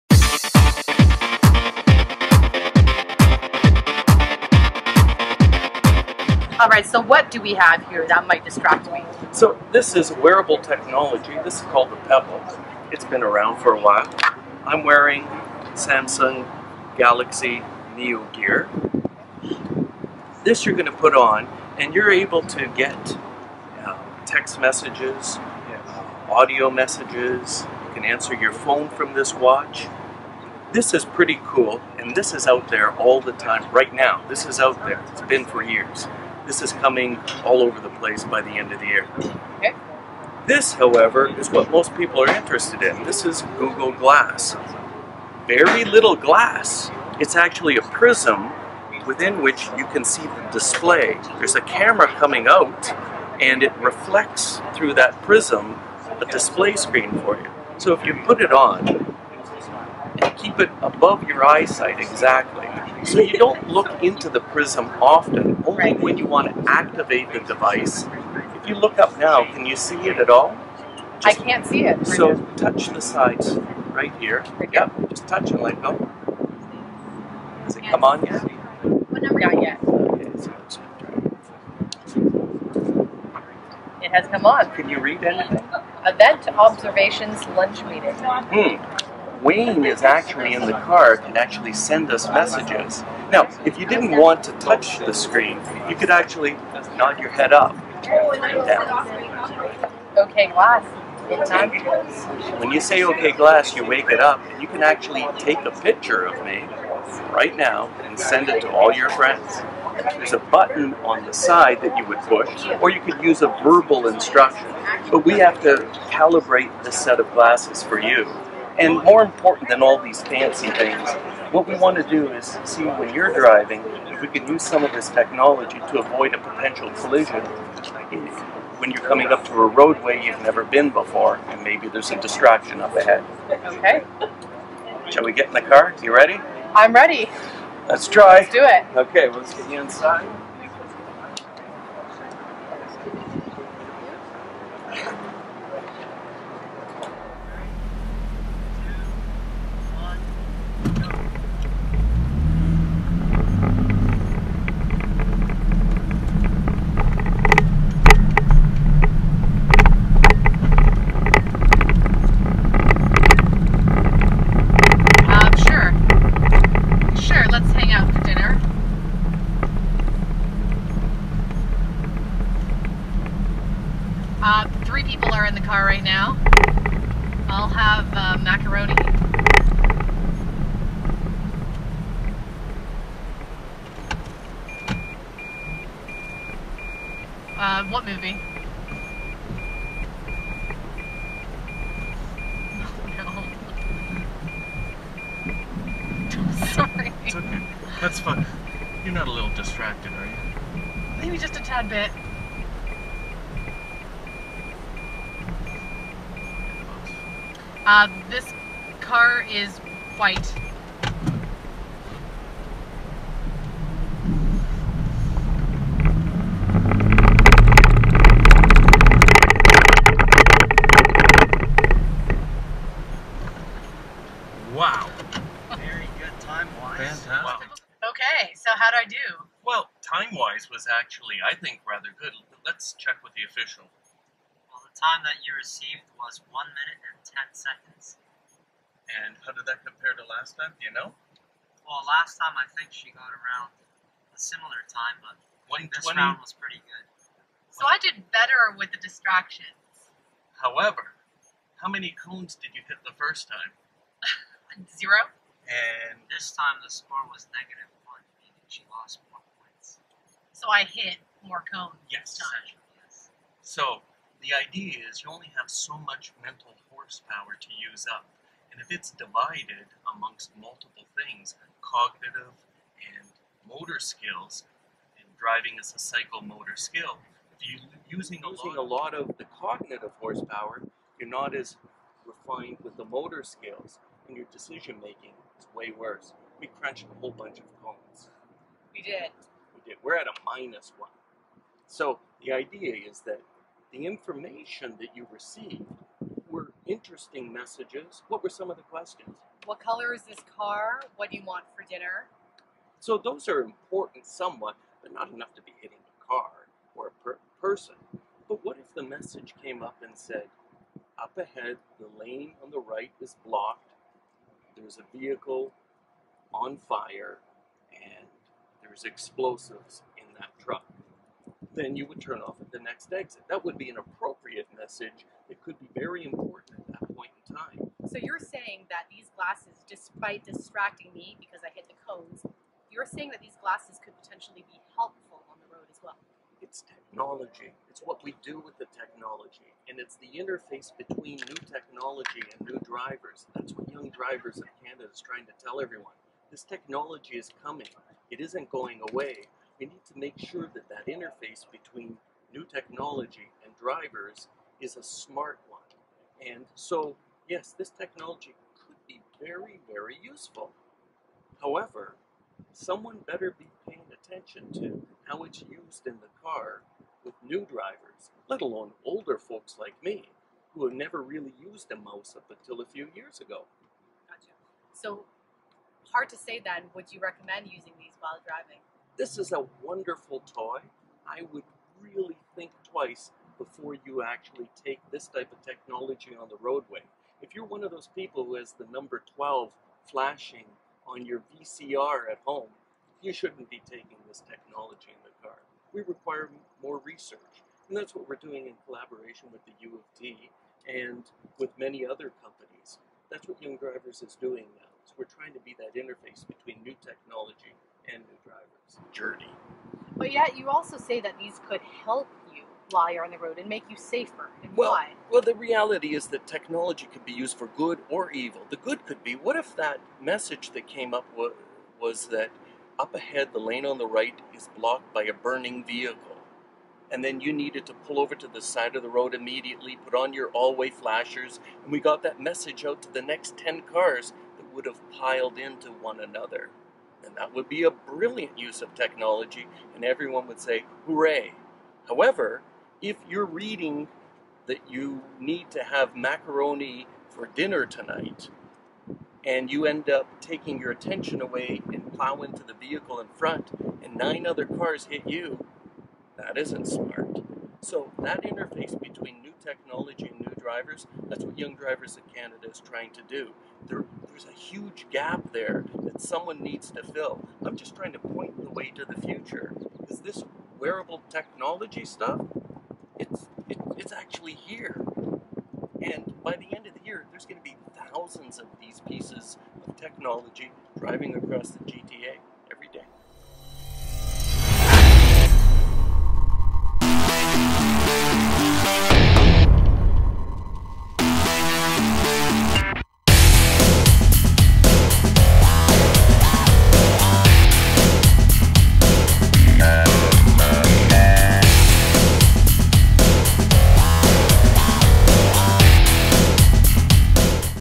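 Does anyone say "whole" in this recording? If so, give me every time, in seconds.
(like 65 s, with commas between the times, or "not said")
287 s.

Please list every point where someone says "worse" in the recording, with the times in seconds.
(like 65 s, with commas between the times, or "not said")
285 s.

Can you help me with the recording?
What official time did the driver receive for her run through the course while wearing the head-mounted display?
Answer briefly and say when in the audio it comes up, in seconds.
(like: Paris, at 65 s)
1 minute 10 seconds, at 236 s.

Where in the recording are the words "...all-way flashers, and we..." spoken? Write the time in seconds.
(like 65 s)
430 s.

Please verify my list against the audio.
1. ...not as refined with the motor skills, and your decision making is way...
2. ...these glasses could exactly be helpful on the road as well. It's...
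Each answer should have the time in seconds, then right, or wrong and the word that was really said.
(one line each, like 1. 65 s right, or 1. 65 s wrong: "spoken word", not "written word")
1. 281 s right
2. 333 s wrong: "potentially", not "exactly".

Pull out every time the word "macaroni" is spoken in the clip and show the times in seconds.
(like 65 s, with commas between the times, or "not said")
178 s, 446 s.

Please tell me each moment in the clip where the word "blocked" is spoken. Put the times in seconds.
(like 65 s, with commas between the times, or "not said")
313 s, 424 s.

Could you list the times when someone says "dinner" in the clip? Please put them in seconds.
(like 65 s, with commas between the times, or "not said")
301 s, 447 s.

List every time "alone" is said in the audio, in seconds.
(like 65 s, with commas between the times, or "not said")
368 s.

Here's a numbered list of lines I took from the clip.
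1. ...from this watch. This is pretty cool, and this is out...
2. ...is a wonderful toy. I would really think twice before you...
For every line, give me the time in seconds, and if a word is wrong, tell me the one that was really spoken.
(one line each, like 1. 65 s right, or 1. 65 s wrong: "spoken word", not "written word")
1. 28 s right
2. 379 s right.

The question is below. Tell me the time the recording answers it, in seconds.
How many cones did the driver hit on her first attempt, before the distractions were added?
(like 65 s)
254 s.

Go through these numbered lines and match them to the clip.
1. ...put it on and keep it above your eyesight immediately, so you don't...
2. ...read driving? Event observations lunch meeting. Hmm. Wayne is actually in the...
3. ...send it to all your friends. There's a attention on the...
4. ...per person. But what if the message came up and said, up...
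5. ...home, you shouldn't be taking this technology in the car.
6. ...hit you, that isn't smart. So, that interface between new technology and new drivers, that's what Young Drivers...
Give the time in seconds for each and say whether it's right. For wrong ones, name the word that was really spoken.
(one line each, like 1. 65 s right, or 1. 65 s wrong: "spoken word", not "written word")
1. 58 s wrong: "exactly", not "immediately"
2. 84 s wrong: "anything", not "driving"
3. 108 s wrong: "button", not "attention"
4. 307 s right
5. 392 s right
6. 455 s right.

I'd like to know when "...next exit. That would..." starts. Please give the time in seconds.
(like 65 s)
322 s.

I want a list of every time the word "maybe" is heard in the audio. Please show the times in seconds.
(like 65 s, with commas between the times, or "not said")
131 s, 201 s.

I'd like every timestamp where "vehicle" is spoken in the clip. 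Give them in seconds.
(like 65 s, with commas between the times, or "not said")
315 s, 425 s, 452 s.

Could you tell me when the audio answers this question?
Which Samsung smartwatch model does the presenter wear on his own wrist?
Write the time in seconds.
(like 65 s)
16 s.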